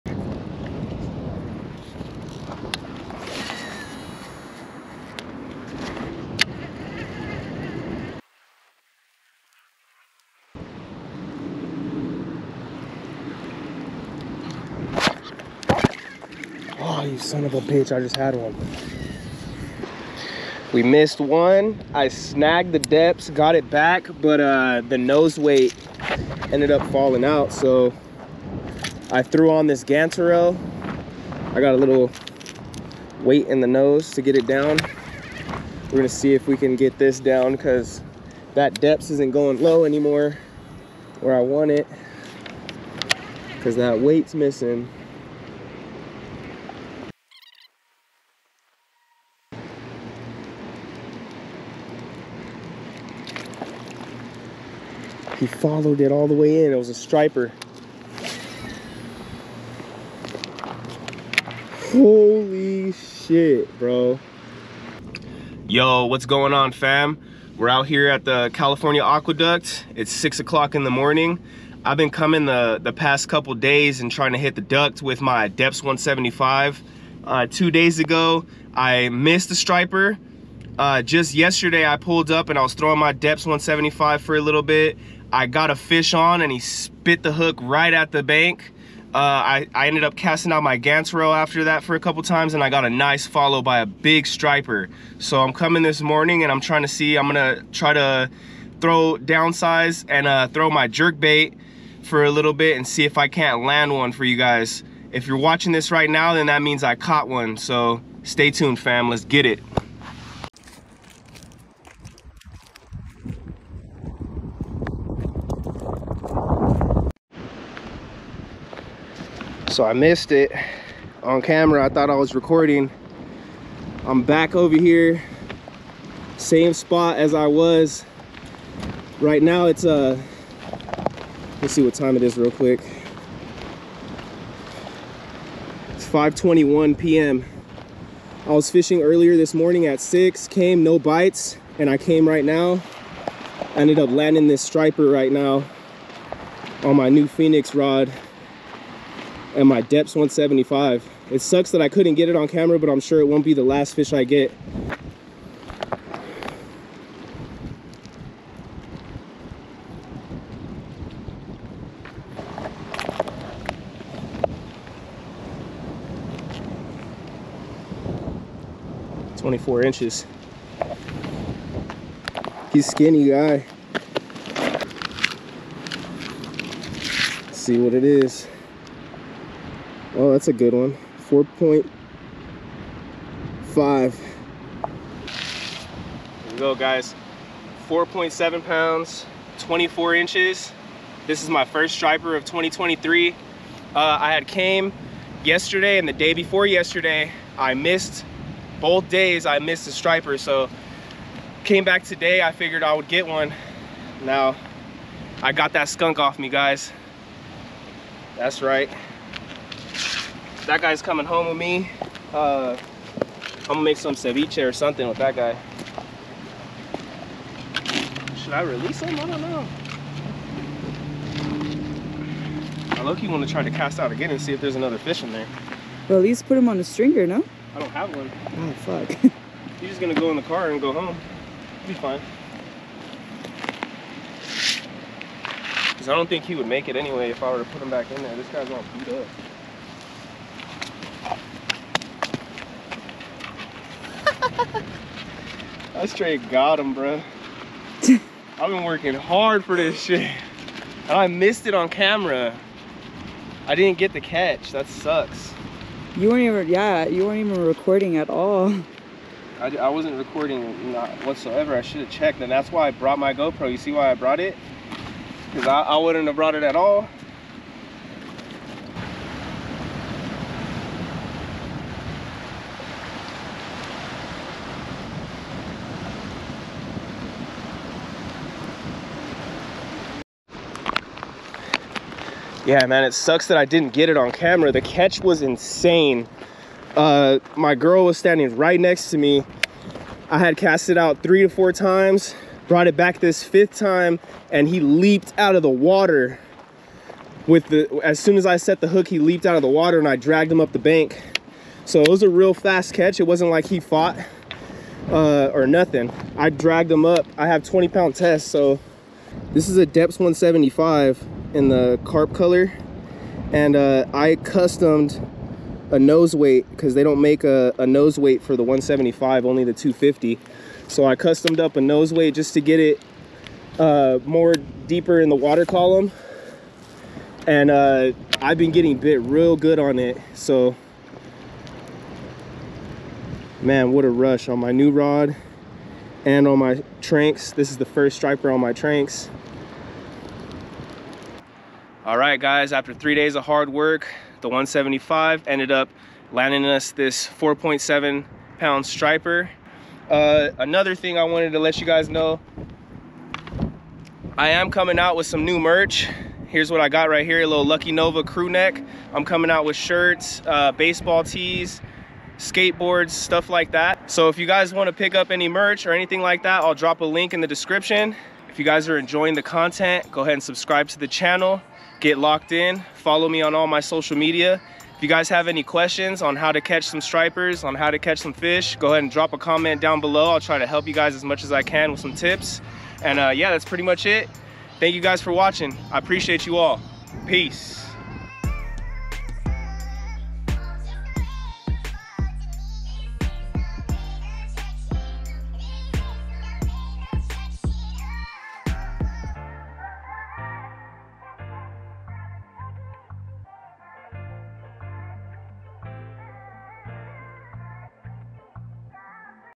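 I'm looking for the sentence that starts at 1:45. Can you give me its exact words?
If you're watching this right now, then that means I caught one.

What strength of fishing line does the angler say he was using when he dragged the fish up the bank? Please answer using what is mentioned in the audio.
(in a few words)
20 pound test.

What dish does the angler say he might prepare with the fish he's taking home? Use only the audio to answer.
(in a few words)
ceviche.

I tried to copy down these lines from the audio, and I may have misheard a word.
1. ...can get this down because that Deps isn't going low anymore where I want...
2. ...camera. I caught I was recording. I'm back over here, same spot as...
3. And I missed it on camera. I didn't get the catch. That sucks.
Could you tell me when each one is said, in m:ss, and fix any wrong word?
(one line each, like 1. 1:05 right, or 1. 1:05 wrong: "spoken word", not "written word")
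1. 0:36 right
2. 2:01 wrong: "thought", not "caught"
3. 4:11 right.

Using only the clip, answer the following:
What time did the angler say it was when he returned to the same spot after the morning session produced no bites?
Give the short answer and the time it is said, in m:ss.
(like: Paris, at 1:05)
5:21 p.m., at 2:16.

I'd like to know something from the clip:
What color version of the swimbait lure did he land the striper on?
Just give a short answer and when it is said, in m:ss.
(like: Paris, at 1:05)
carp, at 5:12.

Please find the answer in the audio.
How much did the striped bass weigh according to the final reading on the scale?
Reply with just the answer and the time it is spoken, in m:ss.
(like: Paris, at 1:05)
4.7 pounds, at 3:07.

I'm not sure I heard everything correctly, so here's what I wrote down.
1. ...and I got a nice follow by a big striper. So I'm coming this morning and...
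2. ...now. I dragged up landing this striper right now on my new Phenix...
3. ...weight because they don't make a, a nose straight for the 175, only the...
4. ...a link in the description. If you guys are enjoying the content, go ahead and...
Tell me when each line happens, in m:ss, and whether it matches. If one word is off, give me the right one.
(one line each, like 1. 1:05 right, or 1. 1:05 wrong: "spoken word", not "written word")
1. 1:32 right
2. 2:22 wrong: "ended", not "dragged"
3. 5:16 wrong: "weight", not "straight"
4. 6:06 right.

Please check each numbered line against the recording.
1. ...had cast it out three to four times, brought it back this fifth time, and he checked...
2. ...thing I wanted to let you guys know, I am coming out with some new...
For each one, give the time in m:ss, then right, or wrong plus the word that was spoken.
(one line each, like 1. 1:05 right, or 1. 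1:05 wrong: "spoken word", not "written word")
1. 4:50 wrong: "leaped", not "checked"
2. 5:50 right.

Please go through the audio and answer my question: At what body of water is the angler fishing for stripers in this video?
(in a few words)
California Aqueduct.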